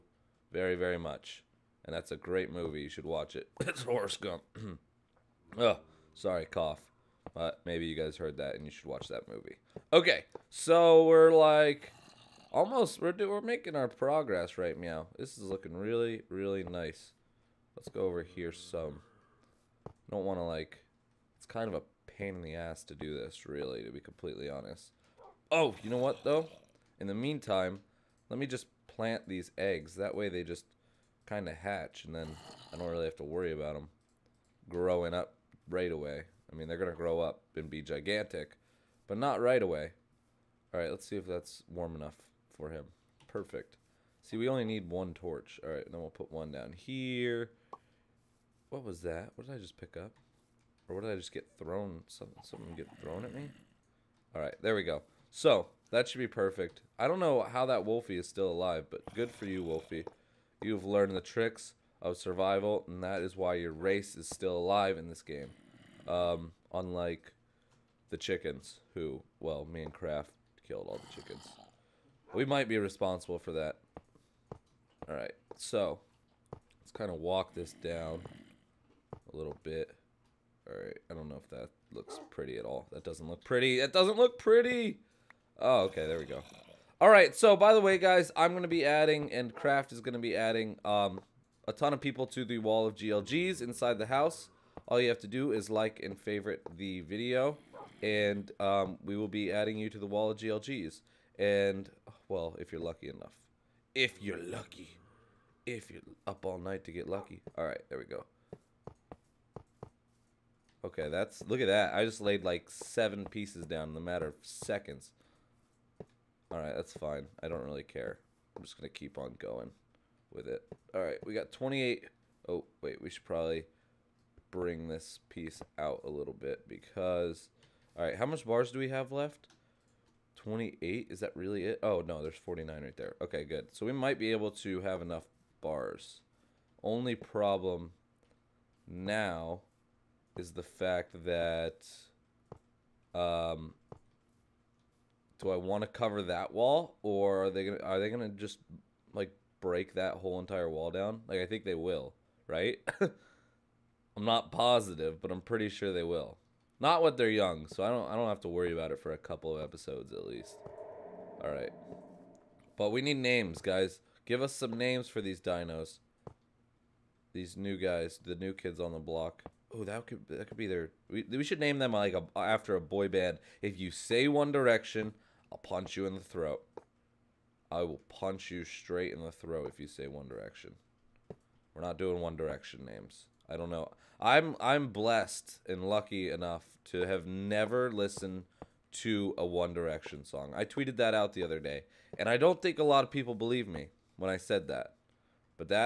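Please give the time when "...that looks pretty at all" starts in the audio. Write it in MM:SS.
01:21.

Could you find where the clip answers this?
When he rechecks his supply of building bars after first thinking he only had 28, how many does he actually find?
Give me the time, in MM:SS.
02:12.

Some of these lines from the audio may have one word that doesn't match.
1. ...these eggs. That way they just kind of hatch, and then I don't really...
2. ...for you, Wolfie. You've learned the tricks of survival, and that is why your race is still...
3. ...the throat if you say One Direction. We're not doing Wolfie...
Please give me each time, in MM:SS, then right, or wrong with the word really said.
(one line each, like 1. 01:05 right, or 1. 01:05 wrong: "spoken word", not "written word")
1. 00:29 right
2. 00:59 right
3. 02:59 wrong: "One", not "Wolfie".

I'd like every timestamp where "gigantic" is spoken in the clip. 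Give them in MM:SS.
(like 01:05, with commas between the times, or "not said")
00:37.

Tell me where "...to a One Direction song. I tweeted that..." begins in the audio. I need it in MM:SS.
03:08.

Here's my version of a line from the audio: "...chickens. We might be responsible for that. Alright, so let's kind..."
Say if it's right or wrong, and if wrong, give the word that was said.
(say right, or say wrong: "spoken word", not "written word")
right.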